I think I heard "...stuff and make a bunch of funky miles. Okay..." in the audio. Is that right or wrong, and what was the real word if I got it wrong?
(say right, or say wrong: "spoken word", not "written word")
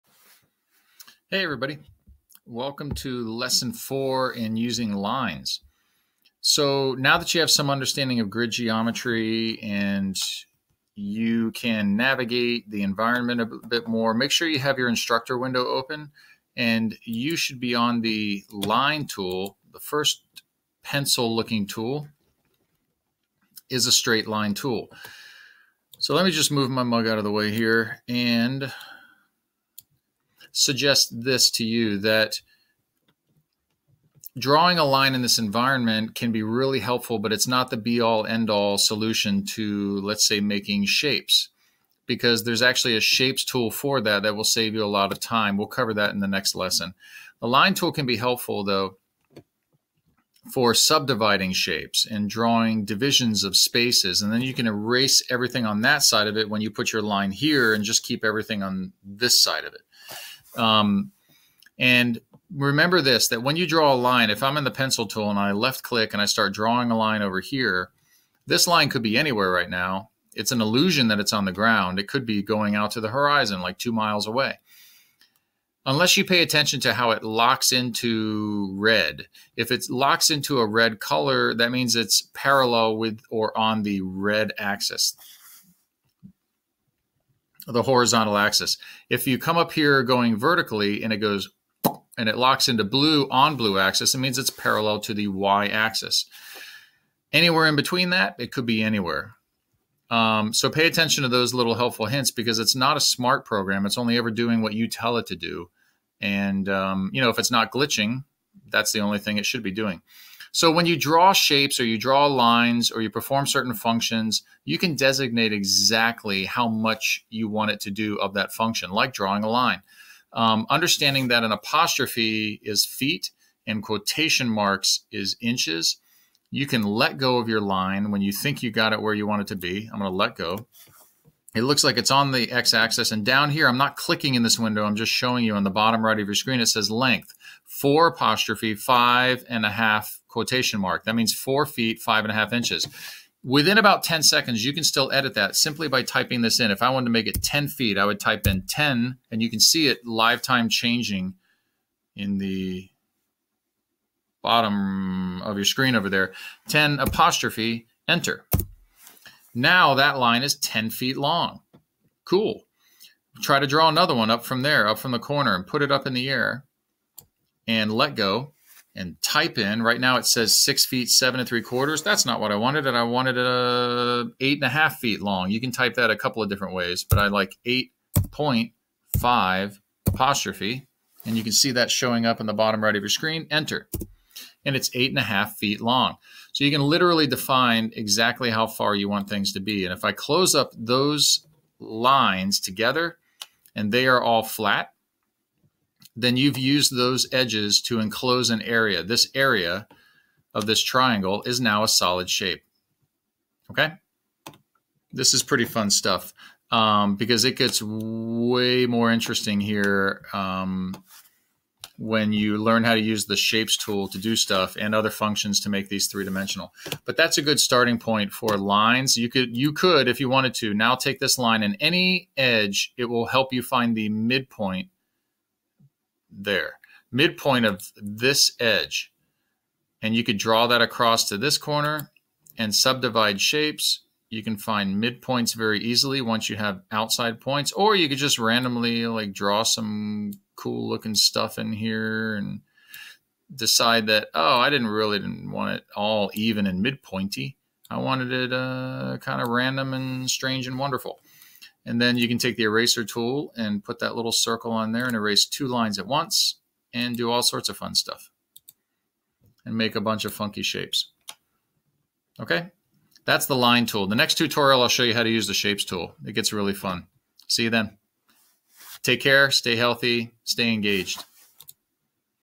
wrong: "shapes", not "miles".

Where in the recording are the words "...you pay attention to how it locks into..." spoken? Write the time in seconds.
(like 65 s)
76 s.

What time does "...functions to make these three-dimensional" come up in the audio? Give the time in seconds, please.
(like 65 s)
215 s.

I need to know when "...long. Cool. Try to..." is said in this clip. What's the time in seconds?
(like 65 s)
161 s.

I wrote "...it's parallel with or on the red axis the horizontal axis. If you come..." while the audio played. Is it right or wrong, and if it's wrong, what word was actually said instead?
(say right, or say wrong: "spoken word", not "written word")
right.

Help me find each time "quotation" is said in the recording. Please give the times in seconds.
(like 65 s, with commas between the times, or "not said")
123 s, 140 s.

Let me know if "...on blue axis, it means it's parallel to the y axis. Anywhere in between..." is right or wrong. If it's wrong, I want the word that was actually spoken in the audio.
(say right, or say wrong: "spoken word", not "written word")
right.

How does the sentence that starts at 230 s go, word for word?
And you could draw that across to this corner and subdivide shapes.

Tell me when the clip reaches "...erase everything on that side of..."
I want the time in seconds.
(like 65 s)
54 s.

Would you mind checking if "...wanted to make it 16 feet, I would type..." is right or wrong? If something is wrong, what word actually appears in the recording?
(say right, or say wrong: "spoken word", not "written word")
wrong: "10", not "16".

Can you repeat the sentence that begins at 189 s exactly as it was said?
And if I close up those lines together and they are all flat, then you've used those edges to enclose an area.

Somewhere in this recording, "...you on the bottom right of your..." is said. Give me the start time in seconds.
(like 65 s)
135 s.